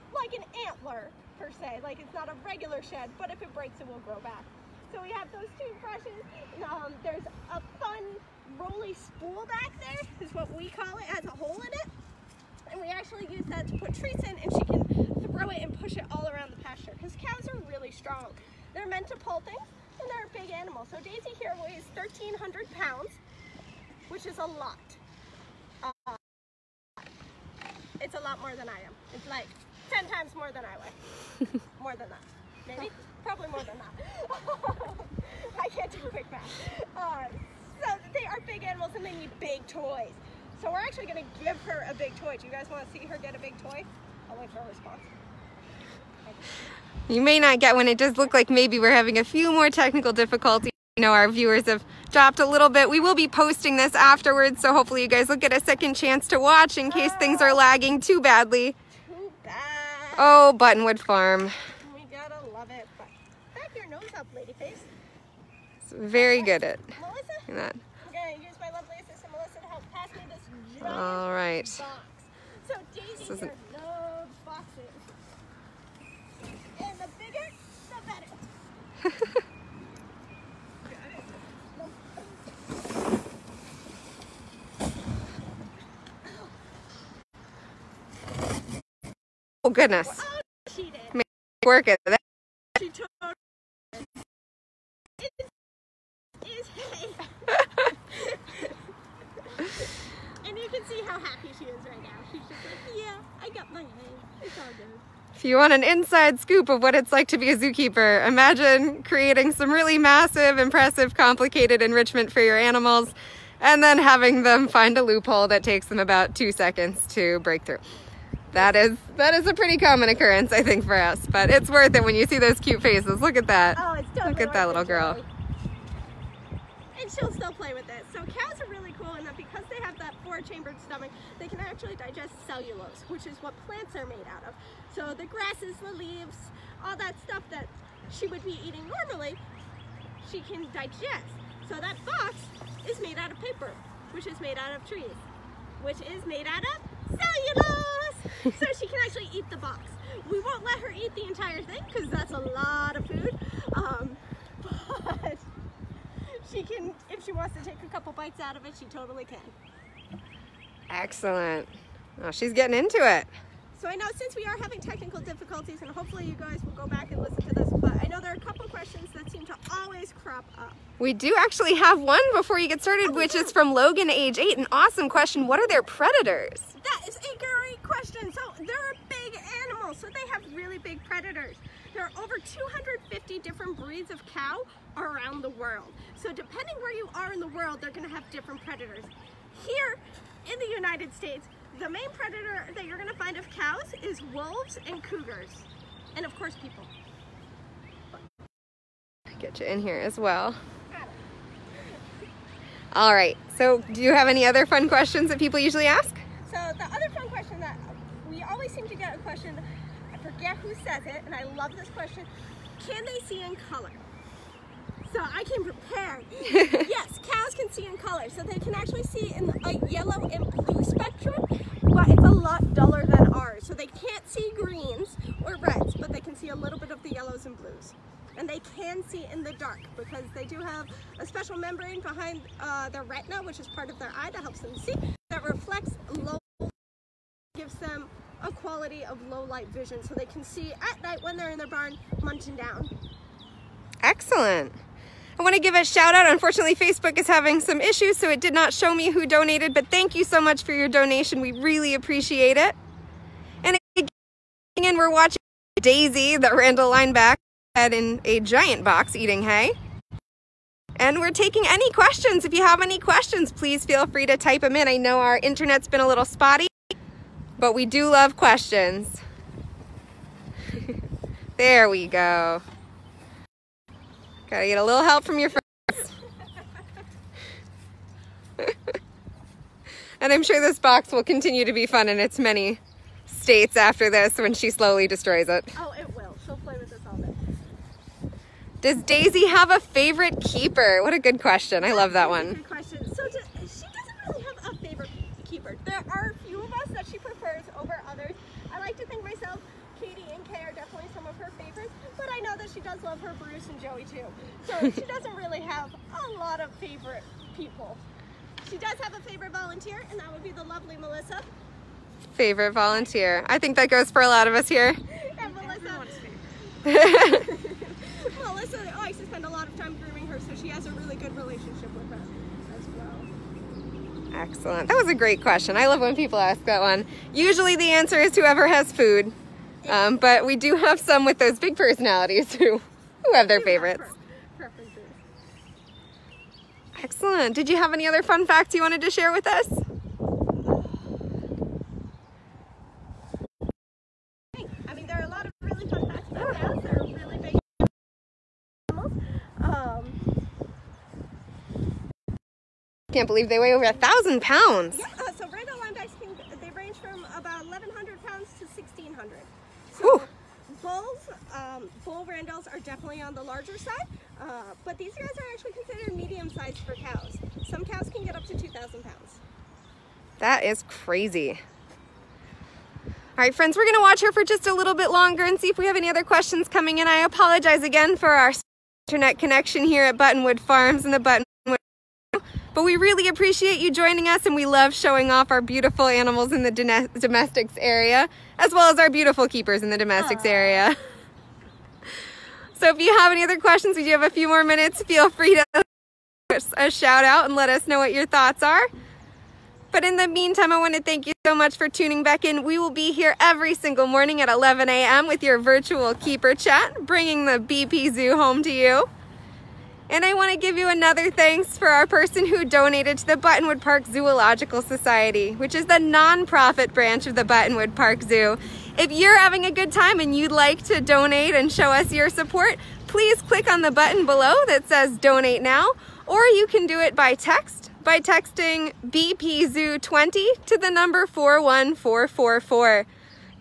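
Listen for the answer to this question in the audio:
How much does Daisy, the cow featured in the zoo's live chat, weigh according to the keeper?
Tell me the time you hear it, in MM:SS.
00:21.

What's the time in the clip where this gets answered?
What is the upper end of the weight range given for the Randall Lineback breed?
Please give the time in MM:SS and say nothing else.
05:58.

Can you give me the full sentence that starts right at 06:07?
Some cows can get up to 2,000 pounds.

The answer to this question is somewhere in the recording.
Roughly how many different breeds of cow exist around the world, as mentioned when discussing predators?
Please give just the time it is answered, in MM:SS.
03:02.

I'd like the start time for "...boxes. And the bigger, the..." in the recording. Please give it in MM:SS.
01:14.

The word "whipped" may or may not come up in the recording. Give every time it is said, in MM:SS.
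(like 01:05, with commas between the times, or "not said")
not said.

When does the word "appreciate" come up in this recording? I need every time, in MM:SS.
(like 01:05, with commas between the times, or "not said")
04:11, 06:23.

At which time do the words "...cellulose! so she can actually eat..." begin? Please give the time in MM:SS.
02:27.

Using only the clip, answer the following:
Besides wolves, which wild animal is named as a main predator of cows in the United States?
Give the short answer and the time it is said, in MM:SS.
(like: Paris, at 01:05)
Cougars, at 03:15.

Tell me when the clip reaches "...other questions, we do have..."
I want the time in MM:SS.
06:33.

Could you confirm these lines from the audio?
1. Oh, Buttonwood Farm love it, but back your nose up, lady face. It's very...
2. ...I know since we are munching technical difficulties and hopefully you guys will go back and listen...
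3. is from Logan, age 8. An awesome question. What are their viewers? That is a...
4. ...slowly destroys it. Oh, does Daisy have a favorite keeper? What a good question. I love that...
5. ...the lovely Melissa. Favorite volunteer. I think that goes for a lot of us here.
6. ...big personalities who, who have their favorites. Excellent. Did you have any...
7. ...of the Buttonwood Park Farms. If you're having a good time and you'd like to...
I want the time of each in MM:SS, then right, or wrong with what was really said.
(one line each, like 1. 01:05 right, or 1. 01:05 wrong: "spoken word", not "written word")
1. 01:00 right
2. 02:43 wrong: "having", not "munching"
3. 02:53 wrong: "predators", not "viewers"
4. 04:44 right
5. 05:10 right
6. 05:31 right
7. 06:57 wrong: "Zoo", not "Farms".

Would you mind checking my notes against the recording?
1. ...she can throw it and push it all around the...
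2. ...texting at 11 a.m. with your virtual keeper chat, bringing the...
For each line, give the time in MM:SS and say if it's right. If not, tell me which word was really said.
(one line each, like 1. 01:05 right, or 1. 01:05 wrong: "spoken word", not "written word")
1. 00:14 right
2. 06:44 wrong: "morning", not "texting".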